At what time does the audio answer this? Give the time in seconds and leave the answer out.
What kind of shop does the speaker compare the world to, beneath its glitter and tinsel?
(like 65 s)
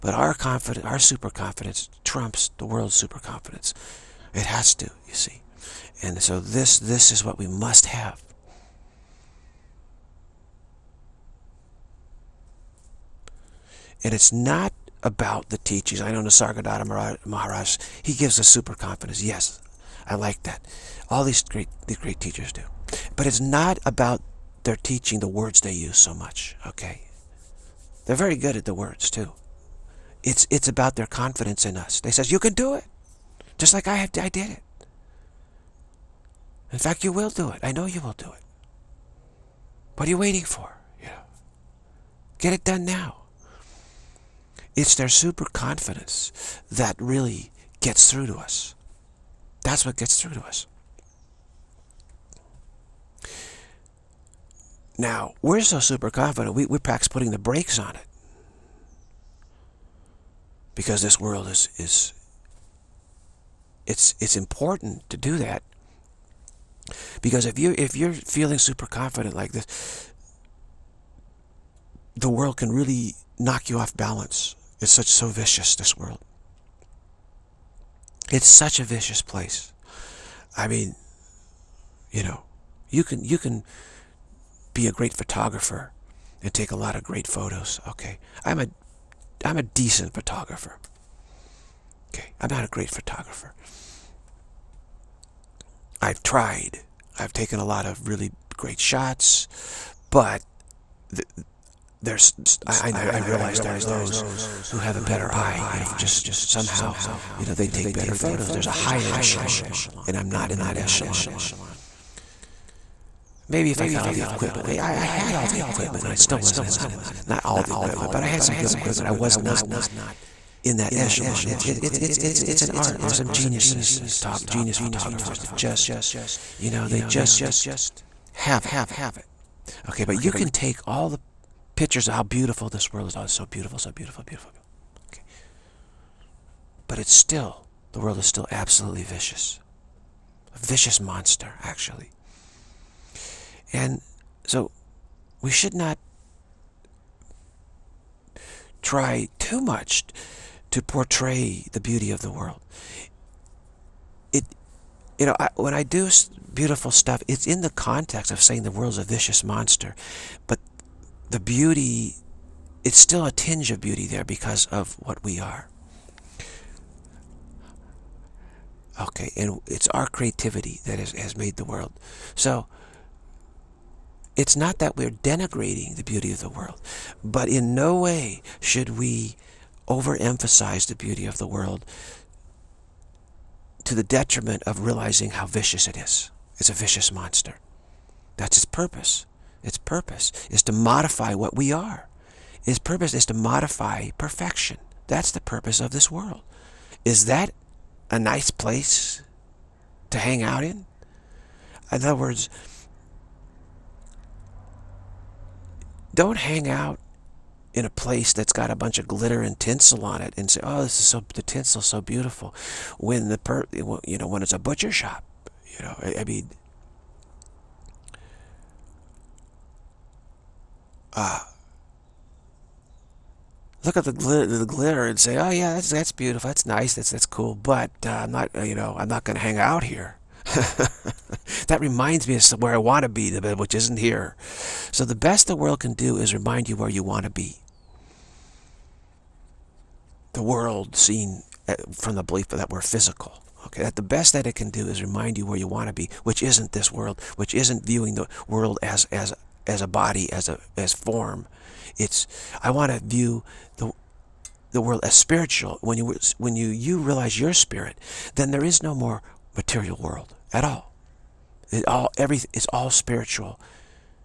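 214 s.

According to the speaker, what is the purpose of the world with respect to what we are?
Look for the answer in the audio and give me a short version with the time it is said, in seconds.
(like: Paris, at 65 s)
to modify perfection, at 193 s.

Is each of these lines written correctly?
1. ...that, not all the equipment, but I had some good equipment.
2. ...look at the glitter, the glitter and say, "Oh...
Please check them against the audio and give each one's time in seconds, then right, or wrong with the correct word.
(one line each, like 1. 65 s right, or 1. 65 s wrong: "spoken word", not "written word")
1. 116 s right
2. 223 s right.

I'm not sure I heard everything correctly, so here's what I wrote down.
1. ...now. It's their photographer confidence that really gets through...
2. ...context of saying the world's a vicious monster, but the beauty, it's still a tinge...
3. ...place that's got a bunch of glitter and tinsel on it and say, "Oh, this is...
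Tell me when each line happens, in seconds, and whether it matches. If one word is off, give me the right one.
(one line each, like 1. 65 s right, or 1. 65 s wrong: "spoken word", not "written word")
1. 42 s wrong: "super", not "photographer"
2. 157 s right
3. 207 s right.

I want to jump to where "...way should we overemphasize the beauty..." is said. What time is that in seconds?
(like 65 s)
177 s.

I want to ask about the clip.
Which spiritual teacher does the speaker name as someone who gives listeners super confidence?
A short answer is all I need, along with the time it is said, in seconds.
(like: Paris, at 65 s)
Nisargadatta Maharaj, at 16 s.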